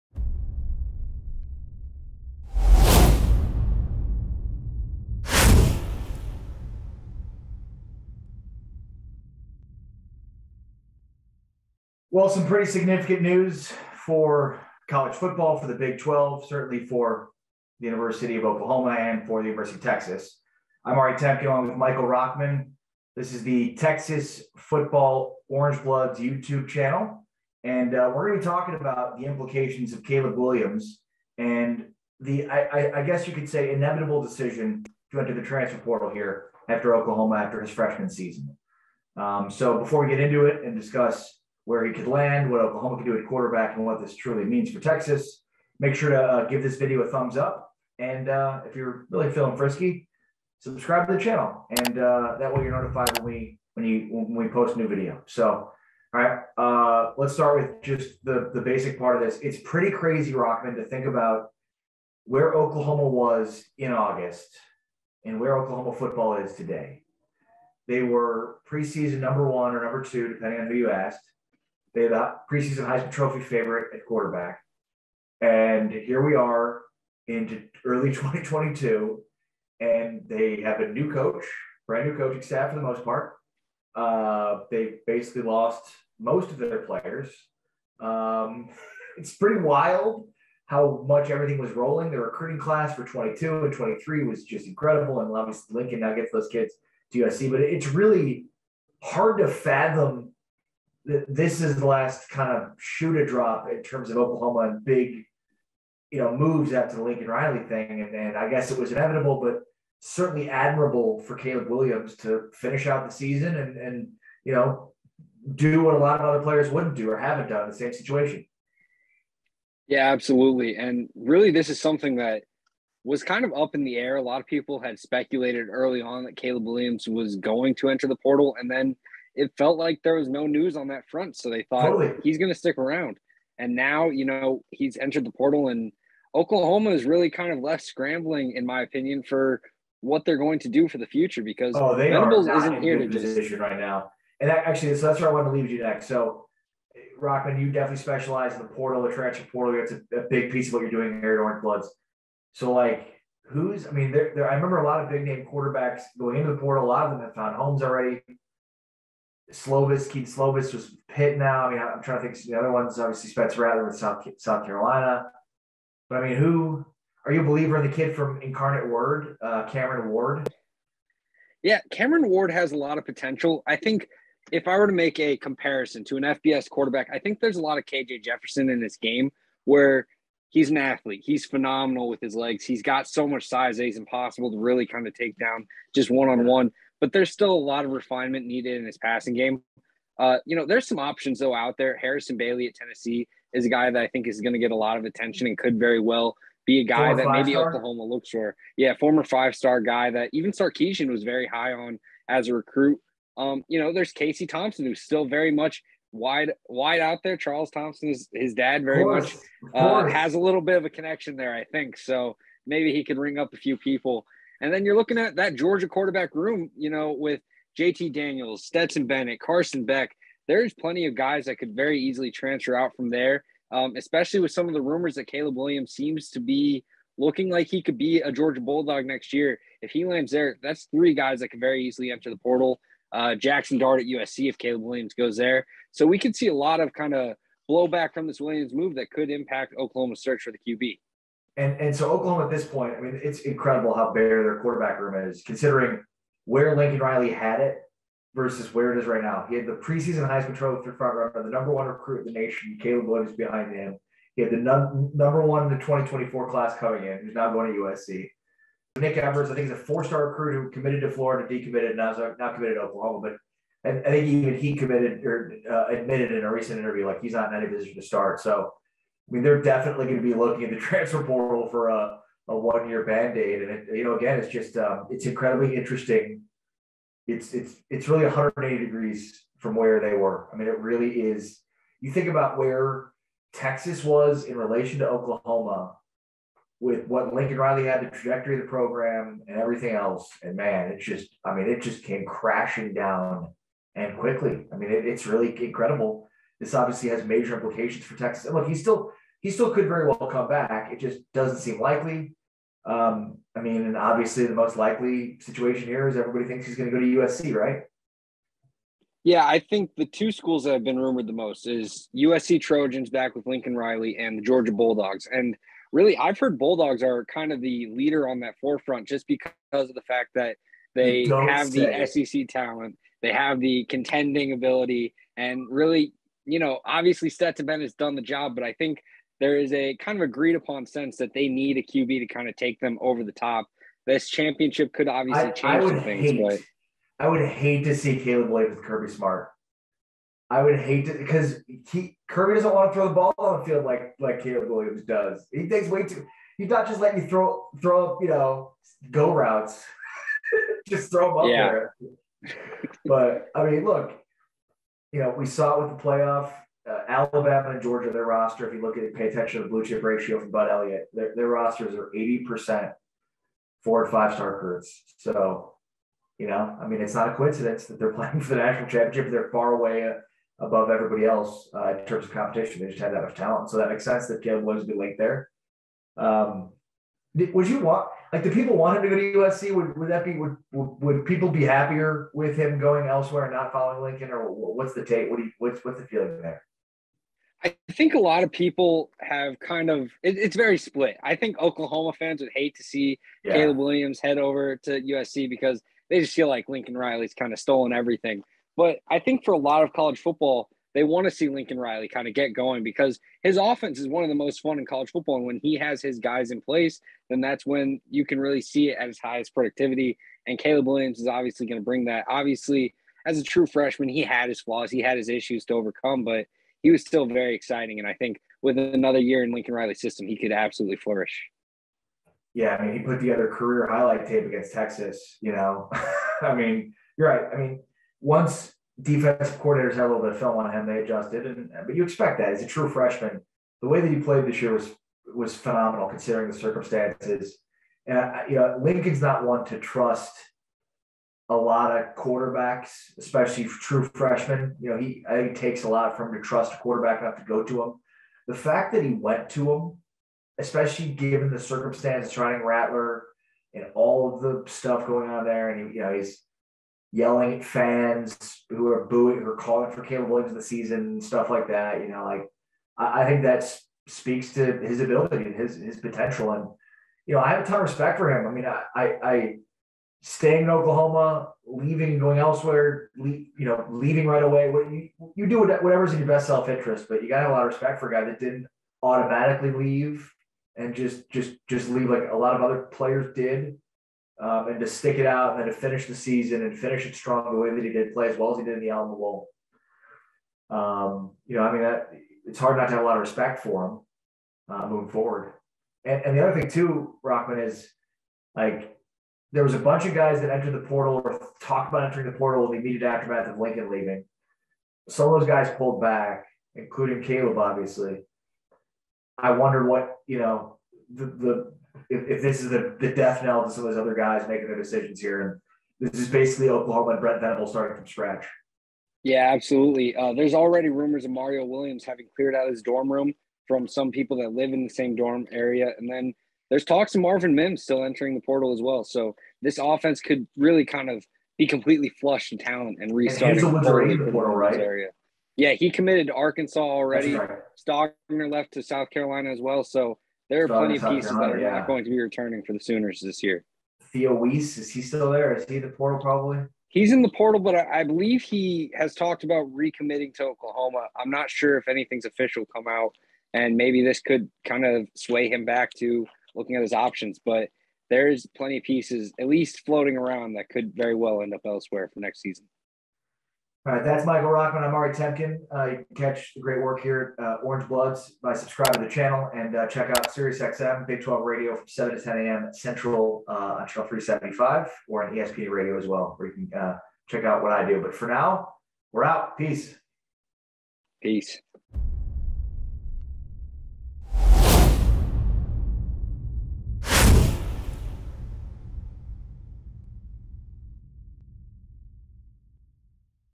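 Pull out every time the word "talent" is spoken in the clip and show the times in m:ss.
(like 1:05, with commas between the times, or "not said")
5:22, 6:13, 8:52.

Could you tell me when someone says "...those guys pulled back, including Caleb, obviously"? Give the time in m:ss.
8:25.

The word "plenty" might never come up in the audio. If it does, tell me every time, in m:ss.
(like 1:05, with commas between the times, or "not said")
3:40, 9:00, 9:18.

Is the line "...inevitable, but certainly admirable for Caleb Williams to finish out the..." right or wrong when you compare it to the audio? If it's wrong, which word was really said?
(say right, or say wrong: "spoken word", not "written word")
right.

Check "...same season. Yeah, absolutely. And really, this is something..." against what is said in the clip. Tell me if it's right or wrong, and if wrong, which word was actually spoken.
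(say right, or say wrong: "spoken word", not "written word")
wrong: "situation", not "season".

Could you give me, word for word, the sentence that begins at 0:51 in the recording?
And uh, that way you're notified when we when you when we post a new video.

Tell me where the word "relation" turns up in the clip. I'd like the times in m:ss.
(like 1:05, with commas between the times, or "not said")
4:44.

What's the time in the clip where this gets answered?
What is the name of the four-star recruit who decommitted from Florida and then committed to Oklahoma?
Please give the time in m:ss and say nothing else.
4:18.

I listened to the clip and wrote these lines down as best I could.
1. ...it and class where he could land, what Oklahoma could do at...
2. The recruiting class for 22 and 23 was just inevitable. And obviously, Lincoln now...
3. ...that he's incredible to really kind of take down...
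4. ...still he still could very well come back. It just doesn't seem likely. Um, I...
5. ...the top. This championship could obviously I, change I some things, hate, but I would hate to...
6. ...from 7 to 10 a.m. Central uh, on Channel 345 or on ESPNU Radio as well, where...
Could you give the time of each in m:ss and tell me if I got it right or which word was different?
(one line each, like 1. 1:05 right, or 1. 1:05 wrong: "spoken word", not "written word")
1. 0:40 wrong: "discuss", not "class"
2. 1:32 wrong: "incredible", not "inevitable"
3. 3:03 wrong: "impossible", not "incredible"
4. 4:58 right
5. 5:33 right
6. 9:31 wrong: "375", not "345".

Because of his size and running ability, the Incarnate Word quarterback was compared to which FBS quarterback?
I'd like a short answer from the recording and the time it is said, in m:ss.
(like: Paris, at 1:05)
KJ Jefferson, at 2:57.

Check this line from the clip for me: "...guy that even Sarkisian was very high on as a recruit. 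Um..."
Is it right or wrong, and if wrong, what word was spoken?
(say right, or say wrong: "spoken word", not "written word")
right.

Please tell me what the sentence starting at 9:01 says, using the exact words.
not going to be returning for the Sooners this year.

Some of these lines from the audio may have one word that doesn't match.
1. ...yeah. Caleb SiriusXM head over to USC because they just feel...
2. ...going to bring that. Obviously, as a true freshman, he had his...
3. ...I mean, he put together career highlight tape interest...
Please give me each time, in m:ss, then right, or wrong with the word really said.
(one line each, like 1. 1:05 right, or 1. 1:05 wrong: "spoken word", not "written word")
1. 6:33 wrong: "Williams", not "SiriusXM"
2. 6:51 right
3. 7:02 wrong: "against", not "interest".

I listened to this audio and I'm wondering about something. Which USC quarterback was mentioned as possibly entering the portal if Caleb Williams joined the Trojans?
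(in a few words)
Jackson Dart.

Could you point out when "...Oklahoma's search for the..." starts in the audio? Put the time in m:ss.
3:59.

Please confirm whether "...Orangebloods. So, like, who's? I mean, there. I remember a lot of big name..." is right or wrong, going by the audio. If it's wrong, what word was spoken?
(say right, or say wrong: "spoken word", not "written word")
right.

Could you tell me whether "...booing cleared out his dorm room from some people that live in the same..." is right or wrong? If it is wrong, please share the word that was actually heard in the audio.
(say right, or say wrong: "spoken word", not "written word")
wrong: "having", not "booing".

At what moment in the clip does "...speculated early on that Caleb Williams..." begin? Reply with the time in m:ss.
2:04.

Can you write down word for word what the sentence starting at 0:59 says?
It's pretty crazy, Rochman, to think about where Oklahoma was in August and where Oklahoma football is today.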